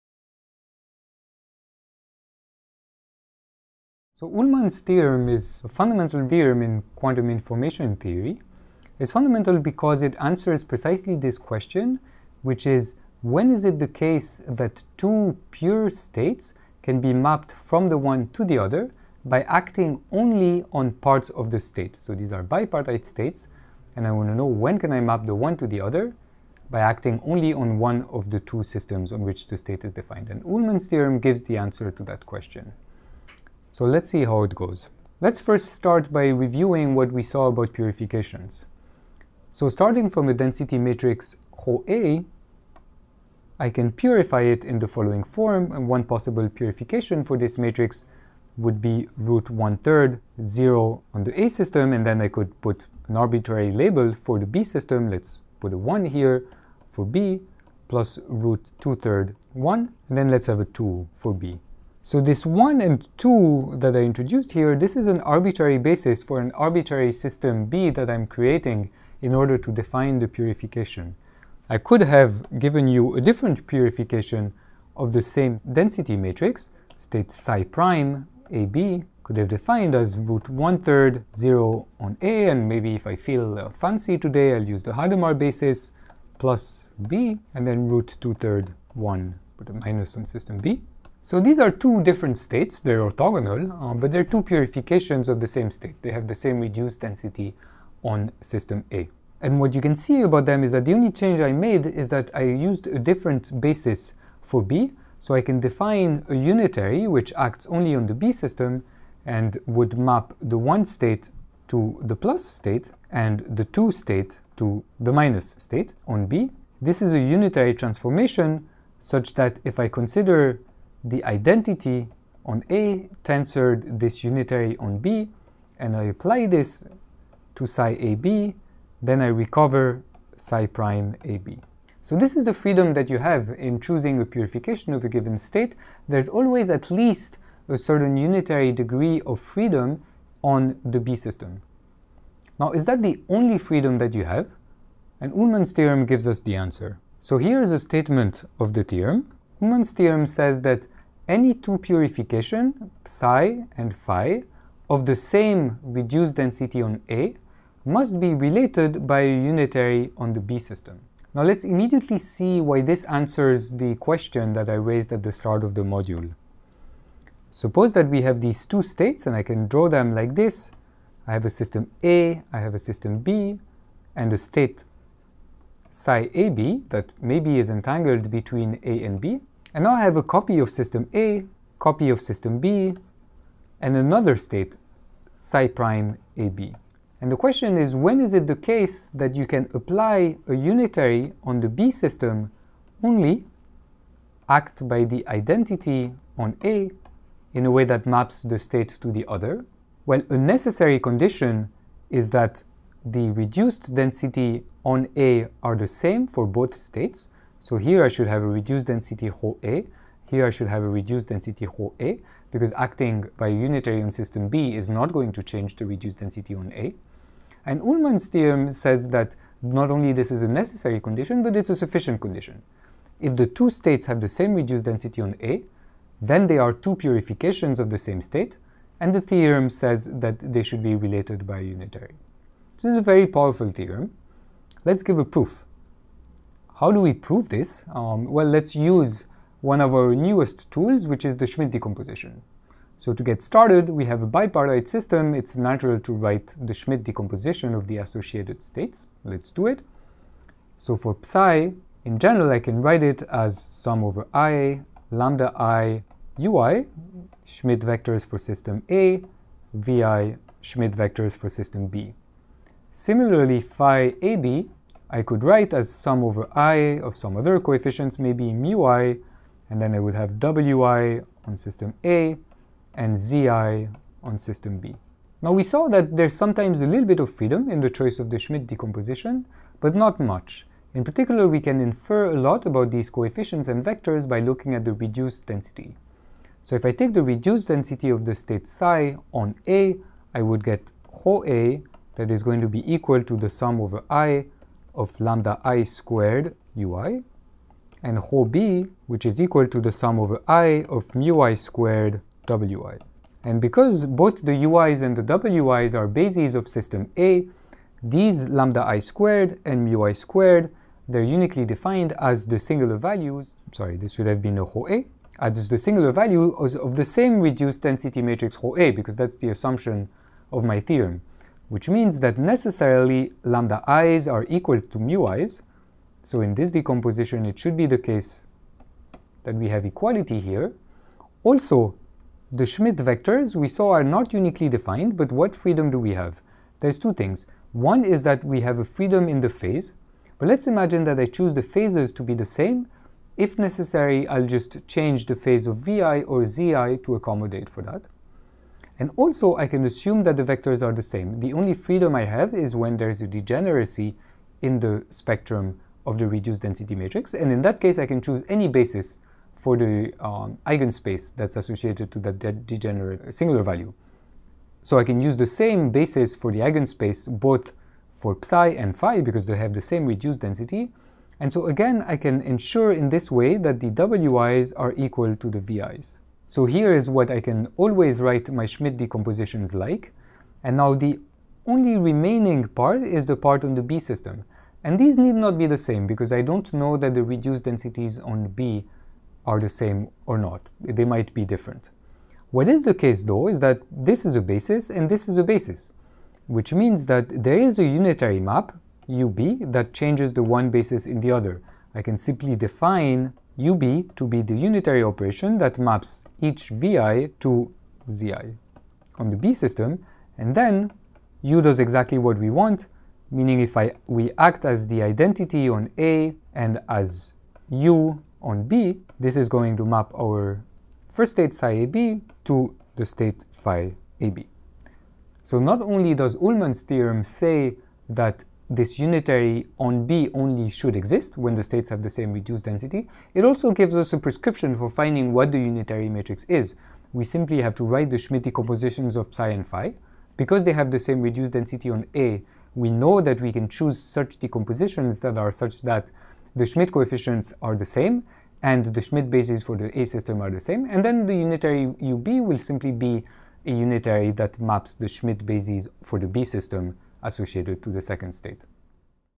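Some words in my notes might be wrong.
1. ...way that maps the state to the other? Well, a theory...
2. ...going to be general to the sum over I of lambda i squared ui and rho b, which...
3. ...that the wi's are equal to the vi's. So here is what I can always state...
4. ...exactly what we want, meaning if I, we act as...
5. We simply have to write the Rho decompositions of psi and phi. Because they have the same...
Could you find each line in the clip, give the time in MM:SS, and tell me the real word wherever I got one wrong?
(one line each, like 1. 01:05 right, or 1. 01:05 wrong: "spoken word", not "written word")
1. 03:17 wrong: "necessary", not "theory"
2. 04:52 wrong: "equal", not "general"
3. 06:13 wrong: "write", not "state"
4. 06:51 right
5. 07:17 wrong: "Schmidt", not "Rho".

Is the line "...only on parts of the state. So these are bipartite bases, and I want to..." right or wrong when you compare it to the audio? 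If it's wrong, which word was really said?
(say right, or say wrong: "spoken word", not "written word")
wrong: "states", not "bases".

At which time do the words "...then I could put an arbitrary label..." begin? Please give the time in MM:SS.
00:52.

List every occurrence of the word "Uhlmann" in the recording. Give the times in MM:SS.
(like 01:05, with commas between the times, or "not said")
00:04, 00:30, 02:25, 02:29, 03:37, 07:06.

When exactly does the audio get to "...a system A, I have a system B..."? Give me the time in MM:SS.
02:51.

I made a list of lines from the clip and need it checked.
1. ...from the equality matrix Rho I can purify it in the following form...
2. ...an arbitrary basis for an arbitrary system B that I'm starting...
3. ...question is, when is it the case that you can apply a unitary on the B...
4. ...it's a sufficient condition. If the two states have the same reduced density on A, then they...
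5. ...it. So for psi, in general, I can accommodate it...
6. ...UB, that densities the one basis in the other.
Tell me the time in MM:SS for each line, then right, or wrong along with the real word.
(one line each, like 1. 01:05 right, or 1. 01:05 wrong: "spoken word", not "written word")
1. 00:40 wrong: "density", not "equality"
2. 01:05 wrong: "creating", not "starting"
3. 03:07 right
4. 03:41 right
5. 04:09 wrong: "write", not "accommodate"
6. 06:39 wrong: "changes", not "densities".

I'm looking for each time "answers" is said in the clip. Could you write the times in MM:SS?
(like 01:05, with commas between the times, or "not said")
00:10, 00:31, 02:26, 02:43.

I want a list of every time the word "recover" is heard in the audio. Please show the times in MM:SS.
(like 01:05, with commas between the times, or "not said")
02:09.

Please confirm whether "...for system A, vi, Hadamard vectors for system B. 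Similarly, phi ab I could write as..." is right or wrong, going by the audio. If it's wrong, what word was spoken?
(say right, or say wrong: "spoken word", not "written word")
wrong: "Schmidt", not "Hadamard".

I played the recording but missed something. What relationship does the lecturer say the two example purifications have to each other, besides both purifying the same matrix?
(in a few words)
orthogonal.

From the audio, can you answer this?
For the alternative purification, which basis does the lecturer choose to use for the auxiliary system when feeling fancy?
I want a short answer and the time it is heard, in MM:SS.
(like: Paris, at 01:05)
Hadamard basis, at 01:24.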